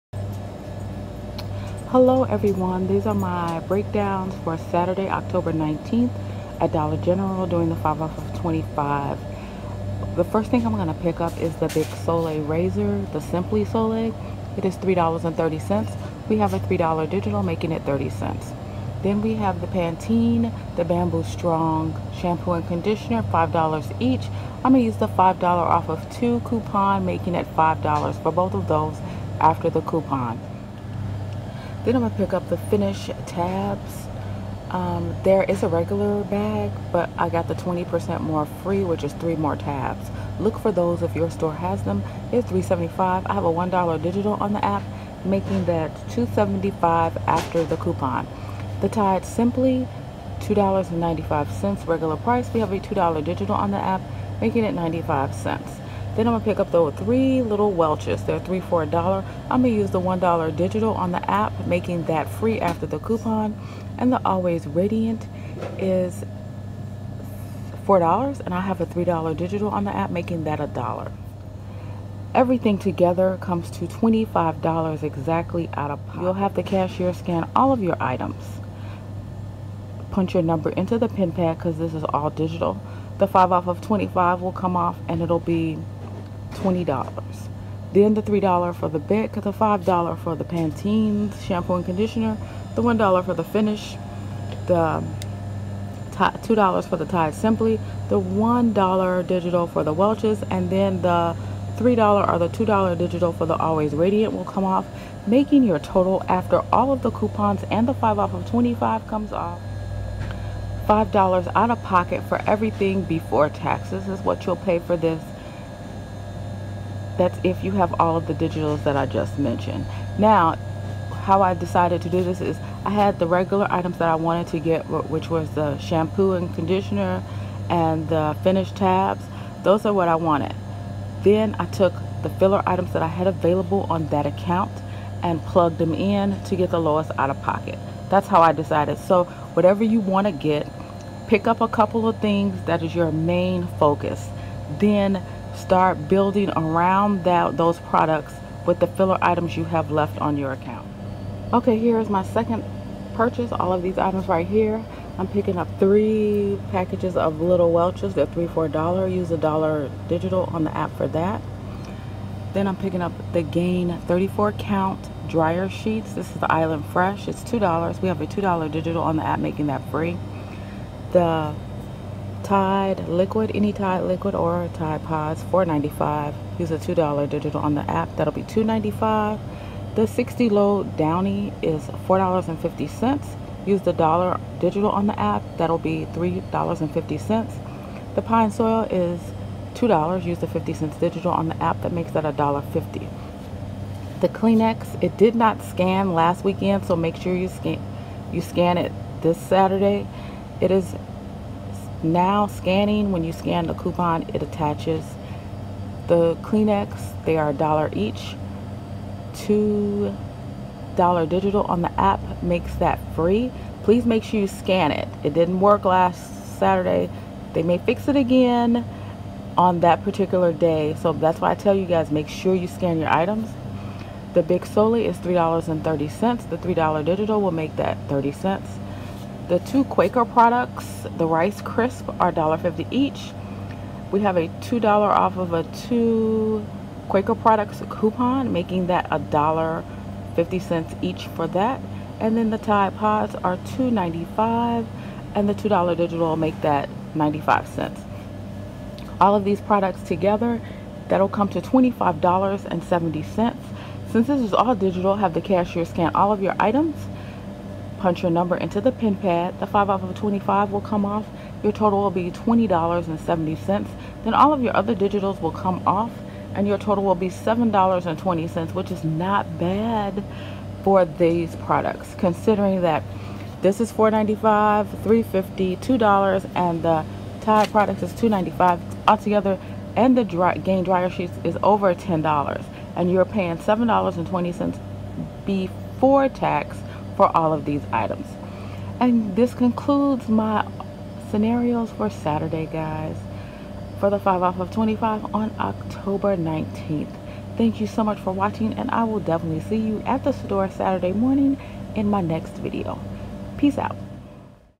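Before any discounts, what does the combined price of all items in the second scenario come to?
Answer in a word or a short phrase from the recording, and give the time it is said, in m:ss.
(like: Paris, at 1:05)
$25.70, at 4:11.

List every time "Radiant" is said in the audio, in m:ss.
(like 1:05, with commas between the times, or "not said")
1:04, 1:43.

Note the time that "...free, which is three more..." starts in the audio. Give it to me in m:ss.
0:38.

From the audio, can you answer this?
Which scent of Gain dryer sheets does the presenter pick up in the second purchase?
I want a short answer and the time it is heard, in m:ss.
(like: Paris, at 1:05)
Island Fresh, at 2:46.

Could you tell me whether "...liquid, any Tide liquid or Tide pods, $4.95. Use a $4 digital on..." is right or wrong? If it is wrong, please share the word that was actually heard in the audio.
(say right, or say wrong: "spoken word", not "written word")
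wrong: "2", not "4".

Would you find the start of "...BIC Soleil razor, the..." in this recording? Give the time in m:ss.
0:11.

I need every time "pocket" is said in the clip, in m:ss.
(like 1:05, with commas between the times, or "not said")
1:16, 1:51, 2:17.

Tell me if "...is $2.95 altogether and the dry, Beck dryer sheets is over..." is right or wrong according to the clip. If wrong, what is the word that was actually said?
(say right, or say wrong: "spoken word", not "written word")
wrong: "Gain", not "Beck".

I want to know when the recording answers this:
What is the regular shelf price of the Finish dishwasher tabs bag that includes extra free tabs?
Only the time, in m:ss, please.
0:42.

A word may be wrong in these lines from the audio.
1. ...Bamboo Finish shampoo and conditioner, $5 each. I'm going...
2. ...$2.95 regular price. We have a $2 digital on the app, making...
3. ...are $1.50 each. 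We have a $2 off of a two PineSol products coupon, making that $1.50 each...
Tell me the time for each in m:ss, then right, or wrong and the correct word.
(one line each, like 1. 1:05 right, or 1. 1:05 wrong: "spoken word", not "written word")
1. 0:20 wrong: "Strong", not "Finish"
2. 0:50 right
3. 3:52 wrong: "Quaker", not "PineSol".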